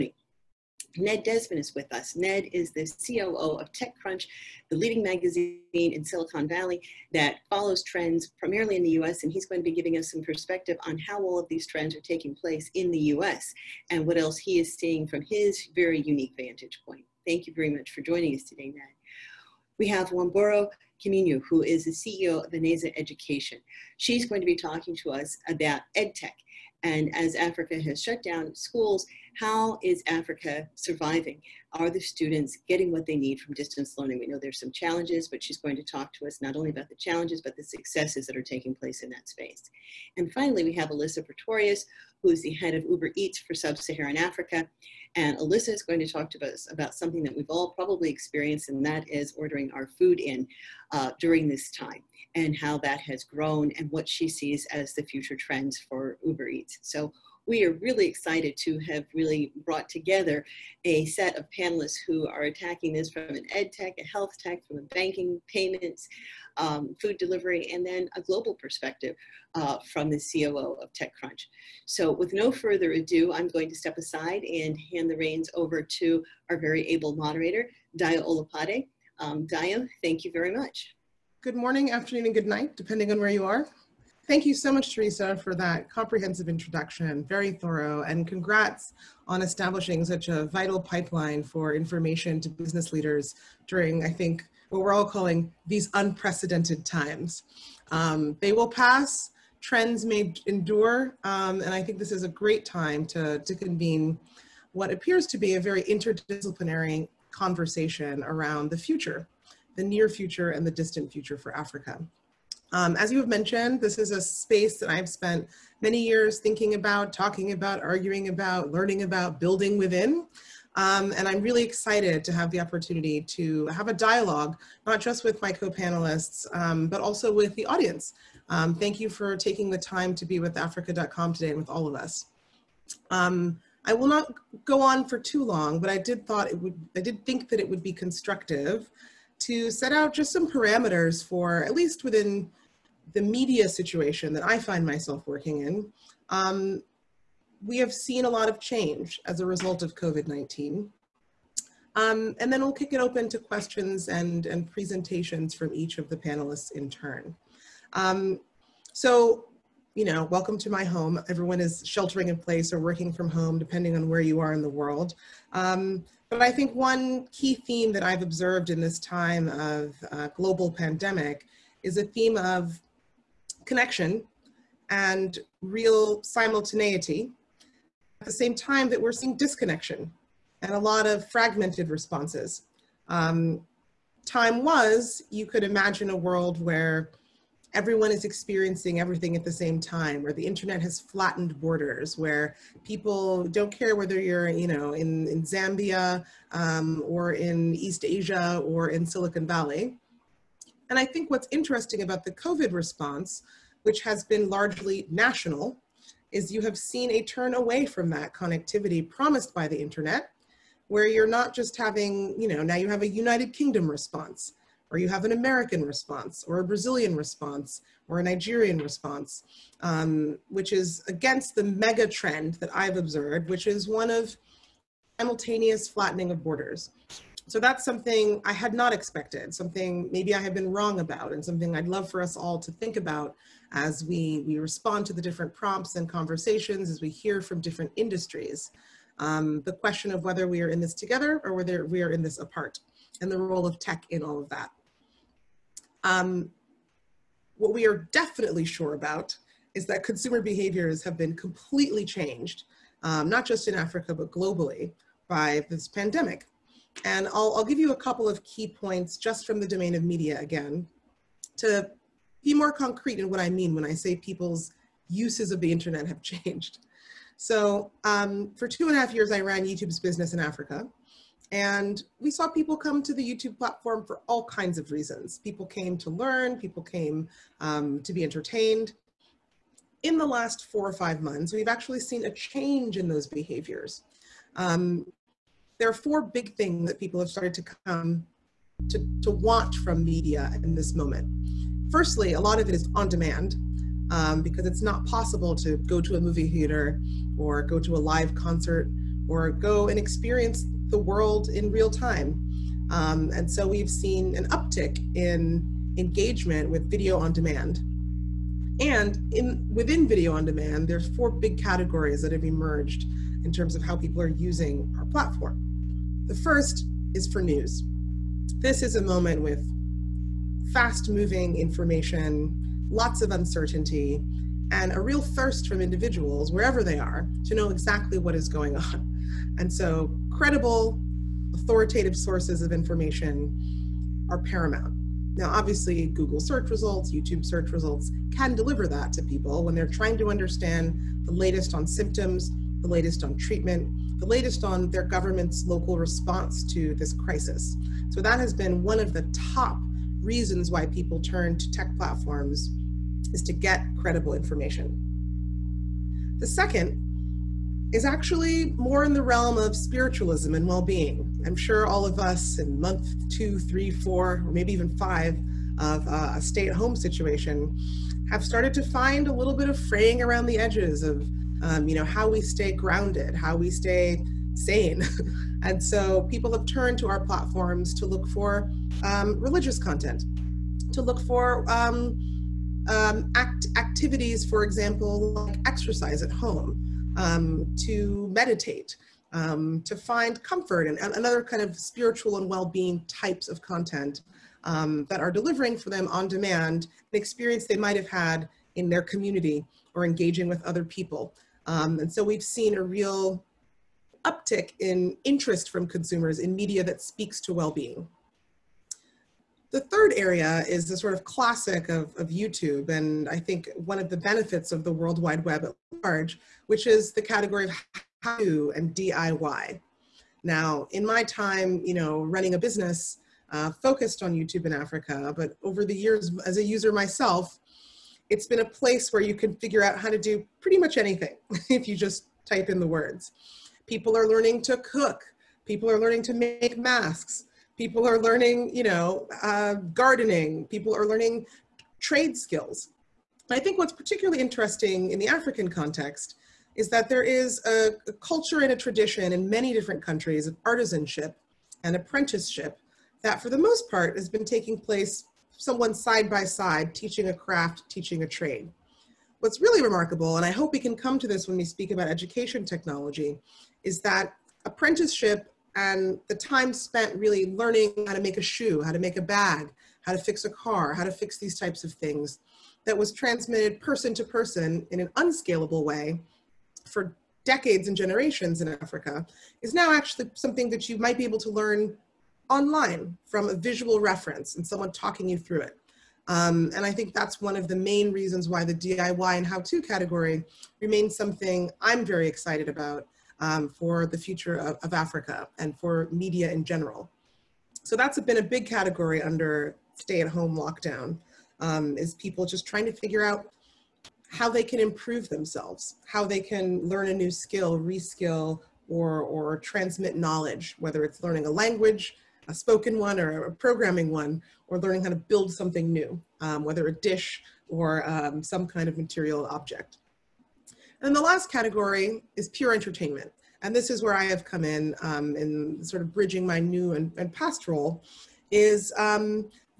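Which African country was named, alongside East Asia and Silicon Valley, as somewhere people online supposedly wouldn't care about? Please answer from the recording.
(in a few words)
Zambia.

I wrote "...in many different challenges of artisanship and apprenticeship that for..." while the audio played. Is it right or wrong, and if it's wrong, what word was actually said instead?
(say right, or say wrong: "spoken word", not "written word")
wrong: "countries", not "challenges".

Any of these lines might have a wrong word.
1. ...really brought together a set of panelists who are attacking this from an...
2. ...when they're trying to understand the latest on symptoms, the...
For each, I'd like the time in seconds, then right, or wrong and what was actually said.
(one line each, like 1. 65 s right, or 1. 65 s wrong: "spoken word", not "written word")
1. 59 s right
2. 339 s right.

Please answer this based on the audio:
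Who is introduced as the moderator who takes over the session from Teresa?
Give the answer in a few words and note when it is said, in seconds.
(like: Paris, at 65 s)
Dayo Olopade, at 77 s.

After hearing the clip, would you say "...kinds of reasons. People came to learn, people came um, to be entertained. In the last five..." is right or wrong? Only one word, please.
wrong.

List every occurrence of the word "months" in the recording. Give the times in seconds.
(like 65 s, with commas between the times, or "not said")
281 s, 362 s.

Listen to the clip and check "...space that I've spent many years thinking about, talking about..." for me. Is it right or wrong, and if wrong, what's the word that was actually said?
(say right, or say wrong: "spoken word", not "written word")
right.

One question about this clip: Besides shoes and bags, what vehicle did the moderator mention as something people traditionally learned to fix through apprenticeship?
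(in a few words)
a car.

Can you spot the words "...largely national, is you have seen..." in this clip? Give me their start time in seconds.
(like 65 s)
204 s.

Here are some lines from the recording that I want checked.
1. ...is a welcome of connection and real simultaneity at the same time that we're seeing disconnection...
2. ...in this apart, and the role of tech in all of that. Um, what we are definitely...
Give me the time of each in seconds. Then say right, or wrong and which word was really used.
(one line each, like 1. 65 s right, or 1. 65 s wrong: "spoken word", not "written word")
1. 171 s wrong: "theme", not "welcome"
2. 242 s right.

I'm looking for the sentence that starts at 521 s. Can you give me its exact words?
And the last category is pure entertainment.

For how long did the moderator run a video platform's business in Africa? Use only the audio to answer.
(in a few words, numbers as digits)
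two and a half years.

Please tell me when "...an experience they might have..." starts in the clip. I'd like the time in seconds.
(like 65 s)
397 s.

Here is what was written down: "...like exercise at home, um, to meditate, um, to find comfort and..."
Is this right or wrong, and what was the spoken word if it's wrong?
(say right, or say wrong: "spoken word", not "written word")
right.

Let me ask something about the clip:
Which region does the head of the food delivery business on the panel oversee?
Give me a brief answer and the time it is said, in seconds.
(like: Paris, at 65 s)
Sub-Saharan Africa, at 43 s.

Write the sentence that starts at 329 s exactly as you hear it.
And so, credible, authoritative sources of information are paramount.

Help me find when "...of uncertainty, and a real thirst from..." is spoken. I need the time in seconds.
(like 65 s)
323 s.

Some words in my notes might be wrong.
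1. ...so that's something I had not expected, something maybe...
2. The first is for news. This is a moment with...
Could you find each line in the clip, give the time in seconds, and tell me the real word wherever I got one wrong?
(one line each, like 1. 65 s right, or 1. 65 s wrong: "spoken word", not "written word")
1. 227 s right
2. 316 s right.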